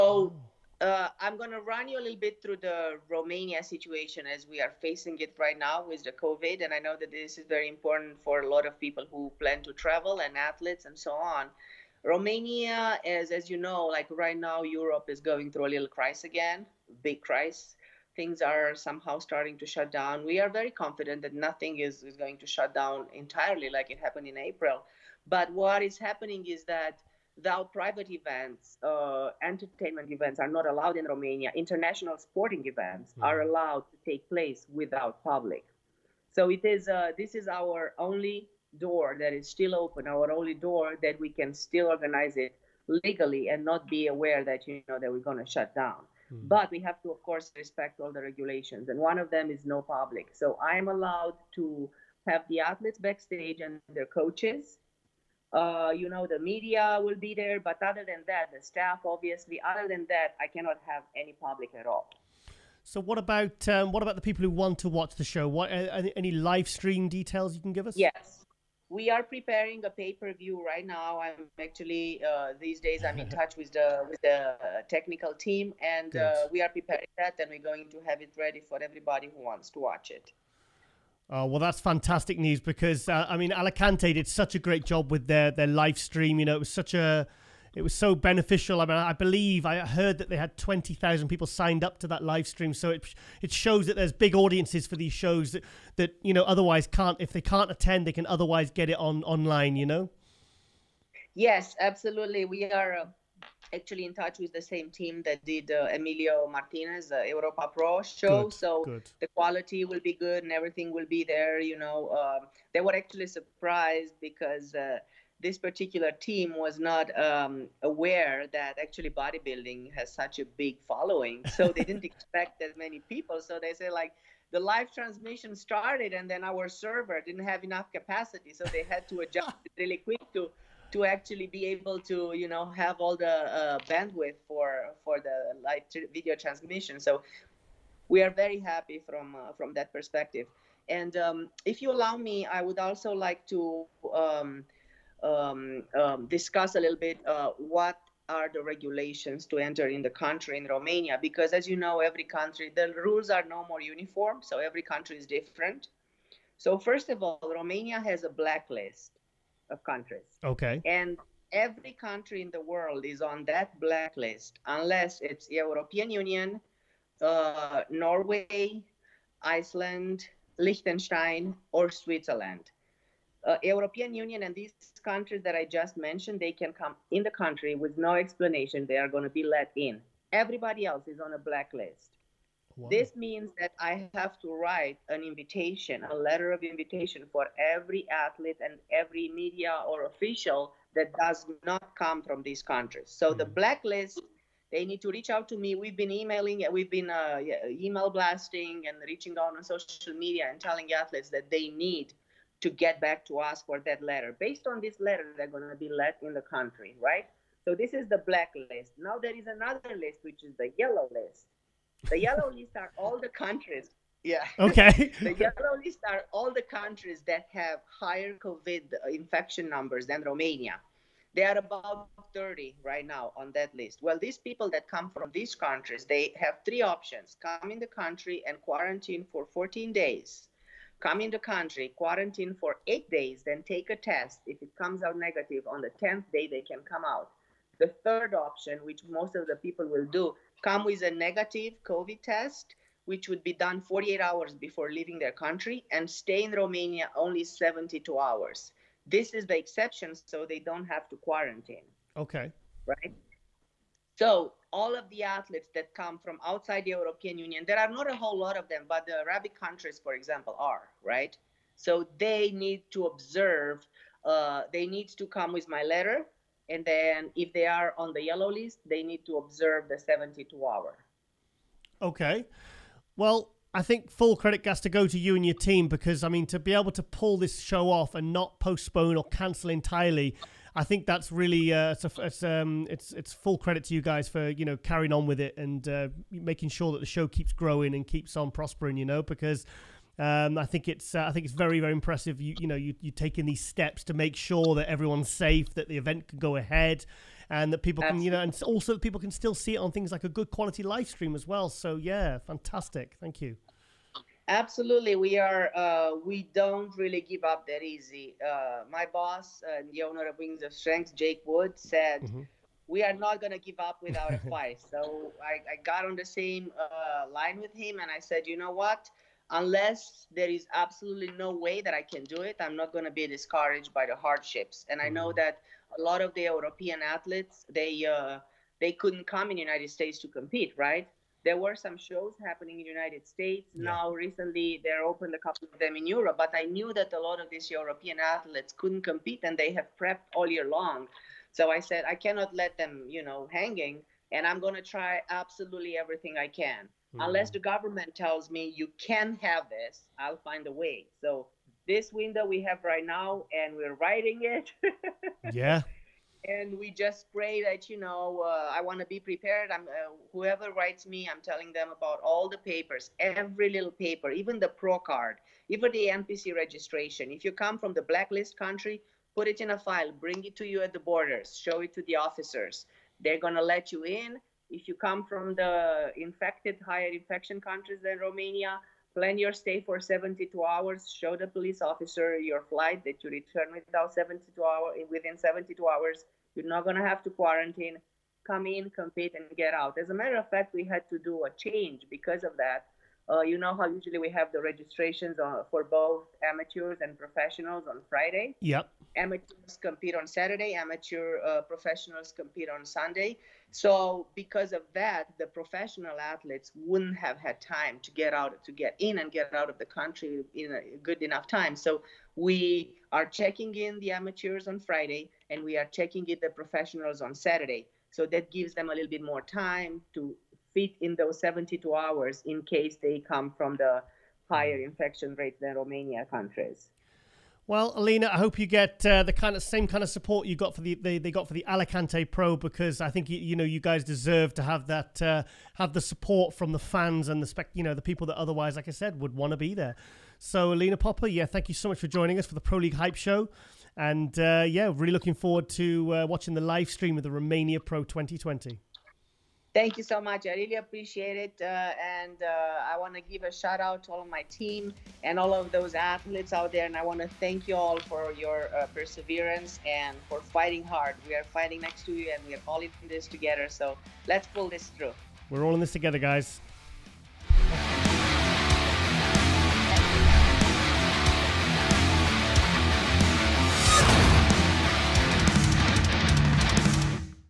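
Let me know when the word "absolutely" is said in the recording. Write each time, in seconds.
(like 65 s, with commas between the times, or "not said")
101 s, 298 s, 304 s, 320 s, 345 s.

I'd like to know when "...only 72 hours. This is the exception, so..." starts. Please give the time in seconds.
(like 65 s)
247 s.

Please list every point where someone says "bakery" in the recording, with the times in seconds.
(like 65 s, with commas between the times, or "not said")
not said.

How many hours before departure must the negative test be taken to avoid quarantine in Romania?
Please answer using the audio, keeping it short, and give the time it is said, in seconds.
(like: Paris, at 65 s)
48, at 243 s.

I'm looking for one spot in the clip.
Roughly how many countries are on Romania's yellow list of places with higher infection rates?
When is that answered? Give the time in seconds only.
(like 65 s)
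222 s.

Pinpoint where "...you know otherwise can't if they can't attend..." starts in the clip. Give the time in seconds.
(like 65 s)
96 s.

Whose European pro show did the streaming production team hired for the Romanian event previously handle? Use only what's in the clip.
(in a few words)
Emilio Martinez.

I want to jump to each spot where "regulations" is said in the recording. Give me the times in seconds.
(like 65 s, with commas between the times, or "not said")
48 s, 148 s.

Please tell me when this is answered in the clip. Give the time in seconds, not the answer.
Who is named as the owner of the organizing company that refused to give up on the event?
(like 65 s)
311 s.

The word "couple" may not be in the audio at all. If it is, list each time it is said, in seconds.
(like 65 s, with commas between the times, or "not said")
335 s.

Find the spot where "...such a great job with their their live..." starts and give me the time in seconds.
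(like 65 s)
84 s.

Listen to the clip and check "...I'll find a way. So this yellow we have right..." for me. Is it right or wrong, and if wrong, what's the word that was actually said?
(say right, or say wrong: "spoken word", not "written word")
wrong: "window", not "yellow".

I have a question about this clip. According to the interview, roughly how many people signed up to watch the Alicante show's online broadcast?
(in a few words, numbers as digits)
20,000.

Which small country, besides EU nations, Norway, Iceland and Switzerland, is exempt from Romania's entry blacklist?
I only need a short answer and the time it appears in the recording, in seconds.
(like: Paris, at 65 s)
Liechtenstein, at 170 s.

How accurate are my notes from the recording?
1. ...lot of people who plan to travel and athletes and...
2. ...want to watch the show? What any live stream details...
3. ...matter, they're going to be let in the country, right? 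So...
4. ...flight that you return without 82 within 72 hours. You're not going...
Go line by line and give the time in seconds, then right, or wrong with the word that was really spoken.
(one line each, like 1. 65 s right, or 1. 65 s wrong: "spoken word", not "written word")
1. 8 s right
2. 64 s right
3. 204 s wrong: "letter", not "matter"
4. 382 s wrong: "72", not "82".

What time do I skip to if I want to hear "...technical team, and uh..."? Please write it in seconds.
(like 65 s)
74 s.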